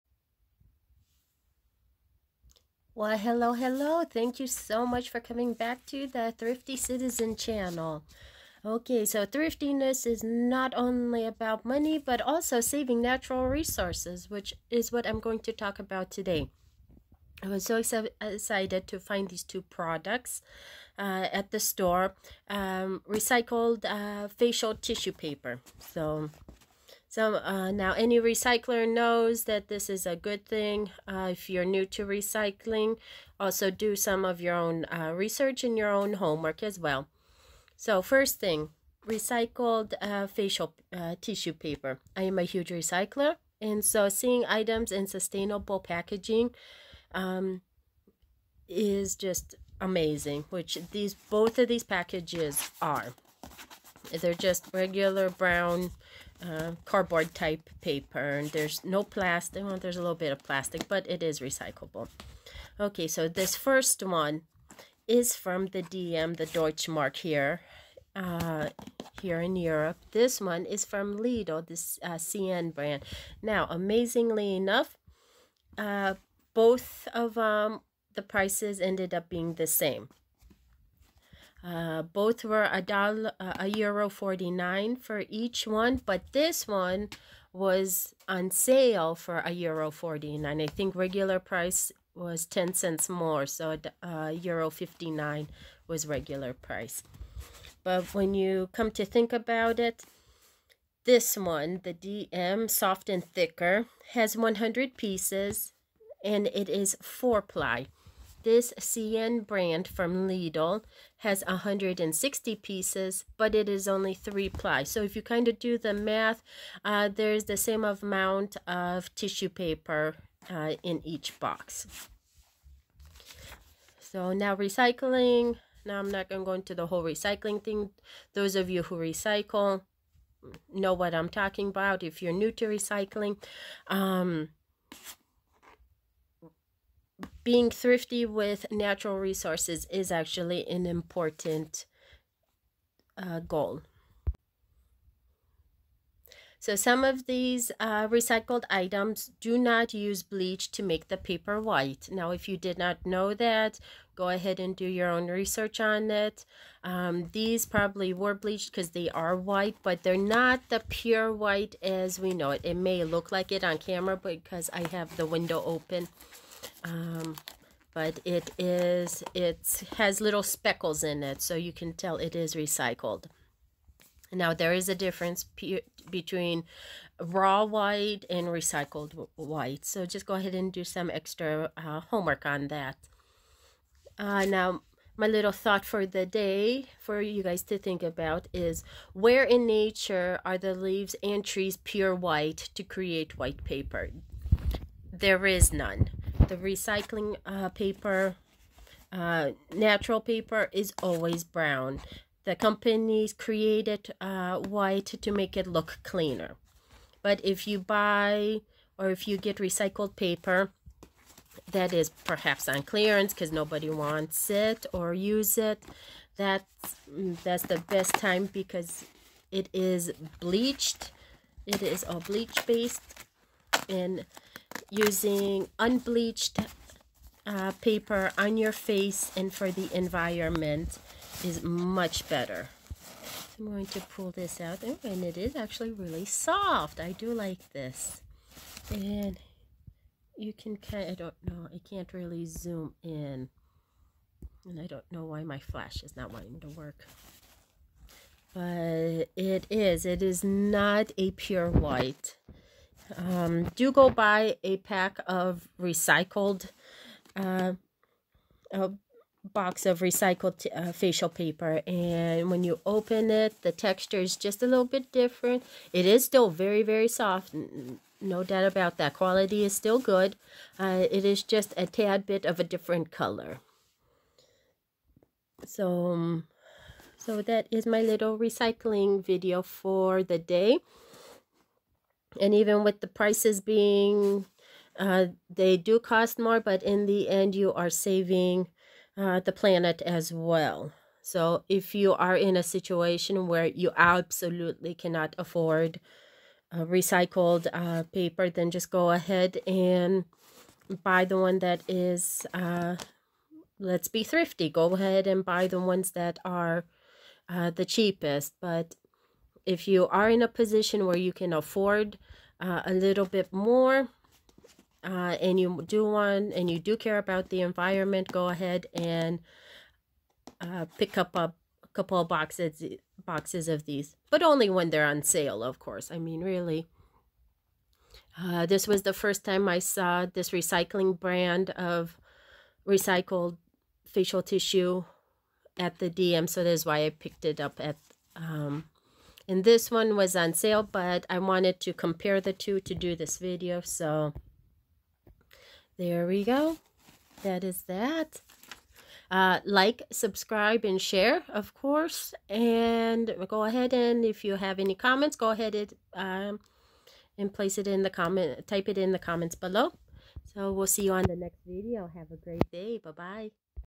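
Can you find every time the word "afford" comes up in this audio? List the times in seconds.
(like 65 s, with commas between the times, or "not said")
295 s, 311 s.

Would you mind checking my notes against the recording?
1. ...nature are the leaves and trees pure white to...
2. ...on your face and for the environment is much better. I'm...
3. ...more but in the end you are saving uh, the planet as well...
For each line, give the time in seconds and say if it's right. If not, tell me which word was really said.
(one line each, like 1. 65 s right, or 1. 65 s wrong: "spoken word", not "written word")
1. 189 s right
2. 228 s right
3. 286 s right.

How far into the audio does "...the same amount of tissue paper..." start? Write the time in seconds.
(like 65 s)
117 s.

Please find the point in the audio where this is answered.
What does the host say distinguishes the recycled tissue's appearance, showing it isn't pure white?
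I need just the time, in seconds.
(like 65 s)
170 s.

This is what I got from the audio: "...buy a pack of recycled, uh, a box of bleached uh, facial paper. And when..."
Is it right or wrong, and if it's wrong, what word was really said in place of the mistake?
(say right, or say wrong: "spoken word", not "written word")
wrong: "recycled", not "bleached".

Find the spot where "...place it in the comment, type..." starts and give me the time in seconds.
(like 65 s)
357 s.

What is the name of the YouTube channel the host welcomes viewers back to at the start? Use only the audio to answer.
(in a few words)
Thrifty Citizen.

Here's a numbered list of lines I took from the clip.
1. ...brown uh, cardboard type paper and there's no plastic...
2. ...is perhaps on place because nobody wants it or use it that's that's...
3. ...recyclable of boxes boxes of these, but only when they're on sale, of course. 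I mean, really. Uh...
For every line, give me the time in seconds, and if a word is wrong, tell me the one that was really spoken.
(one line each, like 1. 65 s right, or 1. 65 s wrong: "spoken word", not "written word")
1. 55 s right
2. 211 s wrong: "clearance", not "place"
3. 321 s wrong: "couple", not "recyclable".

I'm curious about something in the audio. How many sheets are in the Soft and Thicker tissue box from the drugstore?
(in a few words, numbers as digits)
100.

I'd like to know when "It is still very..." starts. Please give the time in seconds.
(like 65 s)
265 s.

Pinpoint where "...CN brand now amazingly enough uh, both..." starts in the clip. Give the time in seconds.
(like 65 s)
72 s.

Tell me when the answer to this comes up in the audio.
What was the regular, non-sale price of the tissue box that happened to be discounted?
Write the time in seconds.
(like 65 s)
94 s.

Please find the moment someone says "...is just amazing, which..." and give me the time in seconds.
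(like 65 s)
48 s.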